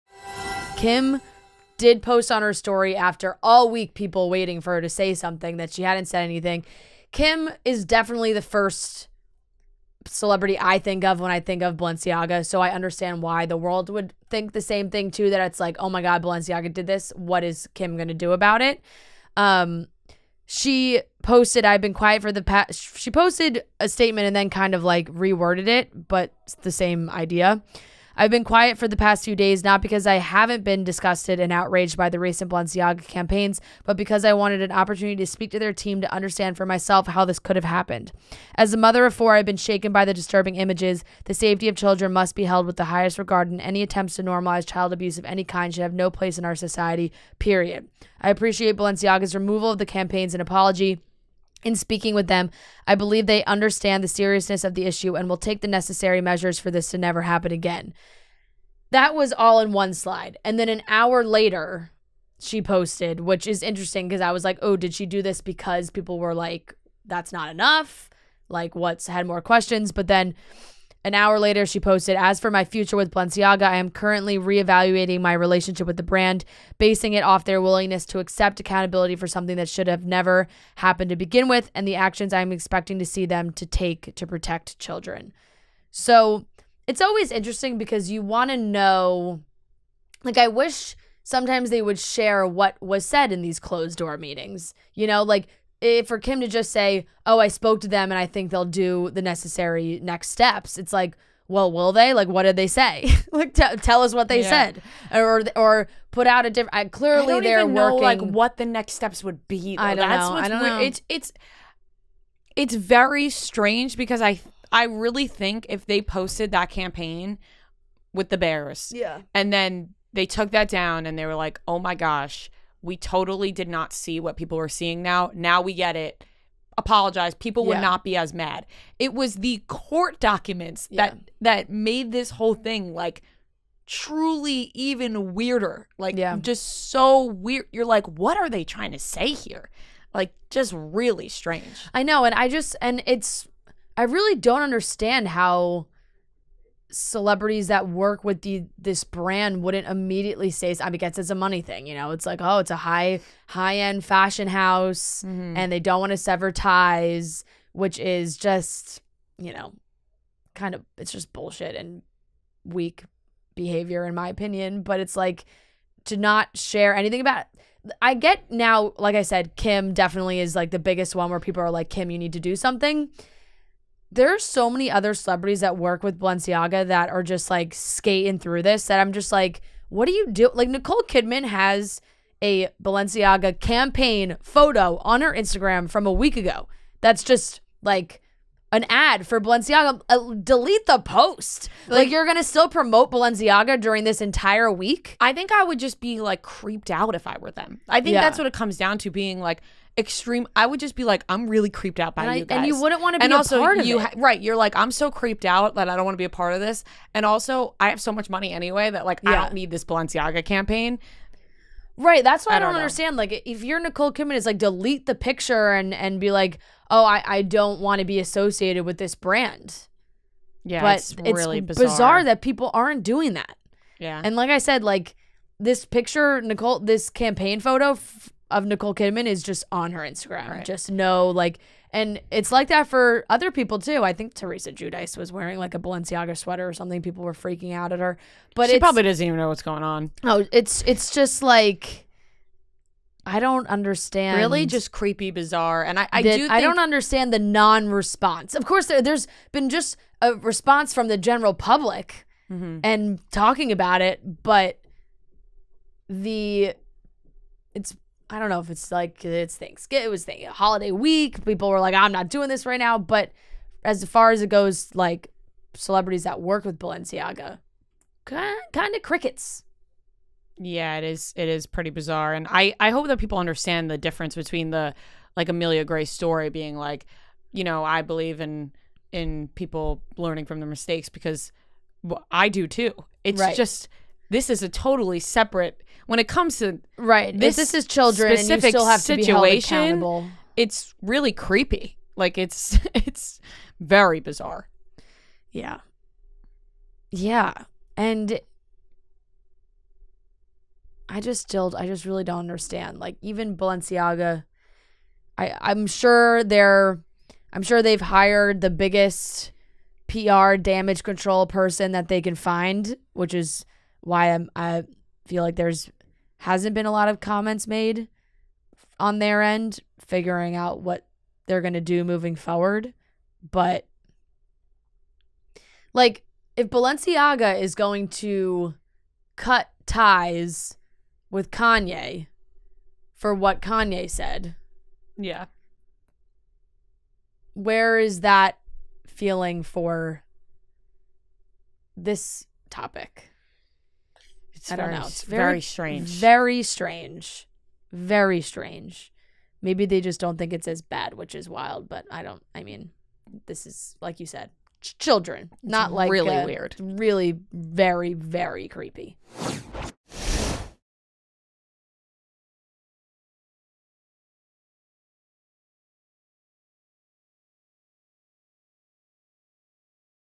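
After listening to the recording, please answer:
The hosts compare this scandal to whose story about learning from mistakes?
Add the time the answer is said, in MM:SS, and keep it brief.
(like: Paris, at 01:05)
Amelia Gray, at 04:35.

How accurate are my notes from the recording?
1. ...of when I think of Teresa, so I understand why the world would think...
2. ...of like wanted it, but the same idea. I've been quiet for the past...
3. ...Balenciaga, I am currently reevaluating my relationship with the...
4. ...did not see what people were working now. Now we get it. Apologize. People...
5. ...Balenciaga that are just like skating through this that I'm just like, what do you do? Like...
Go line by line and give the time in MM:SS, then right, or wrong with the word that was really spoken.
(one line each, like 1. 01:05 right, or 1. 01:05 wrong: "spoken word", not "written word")
1. 00:11 wrong: "Balenciaga", not "Teresa"
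2. 00:24 wrong: "reworded", not "wanted"
3. 01:13 right
4. 02:03 wrong: "seeing", not "working"
5. 02:56 right.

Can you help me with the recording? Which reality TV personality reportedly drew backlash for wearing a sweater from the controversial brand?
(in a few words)
Teresa Giudice.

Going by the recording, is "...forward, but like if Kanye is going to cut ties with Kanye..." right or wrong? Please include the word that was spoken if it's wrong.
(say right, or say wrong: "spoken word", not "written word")
wrong: "Balenciaga", not "Kanye".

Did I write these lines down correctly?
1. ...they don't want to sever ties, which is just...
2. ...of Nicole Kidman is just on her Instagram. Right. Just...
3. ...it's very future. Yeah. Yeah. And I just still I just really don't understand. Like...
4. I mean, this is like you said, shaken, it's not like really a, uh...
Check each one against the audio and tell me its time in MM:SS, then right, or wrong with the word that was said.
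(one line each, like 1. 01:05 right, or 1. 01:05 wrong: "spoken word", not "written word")
1. 02:35 right
2. 03:48 right
3. 04:52 wrong: "bizarre", not "future"
4. 05:52 wrong: "children", not "shaken".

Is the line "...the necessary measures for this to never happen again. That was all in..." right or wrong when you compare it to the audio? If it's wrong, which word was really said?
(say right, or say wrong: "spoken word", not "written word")
right.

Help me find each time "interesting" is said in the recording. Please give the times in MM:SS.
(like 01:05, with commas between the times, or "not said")
01:03, 01:27.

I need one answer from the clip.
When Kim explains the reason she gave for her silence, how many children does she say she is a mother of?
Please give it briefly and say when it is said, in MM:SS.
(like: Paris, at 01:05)
4, at 00:39.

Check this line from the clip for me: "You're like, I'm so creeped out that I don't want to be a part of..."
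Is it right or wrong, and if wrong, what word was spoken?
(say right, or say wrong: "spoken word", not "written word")
right.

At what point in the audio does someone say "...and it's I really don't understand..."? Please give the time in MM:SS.
02:22.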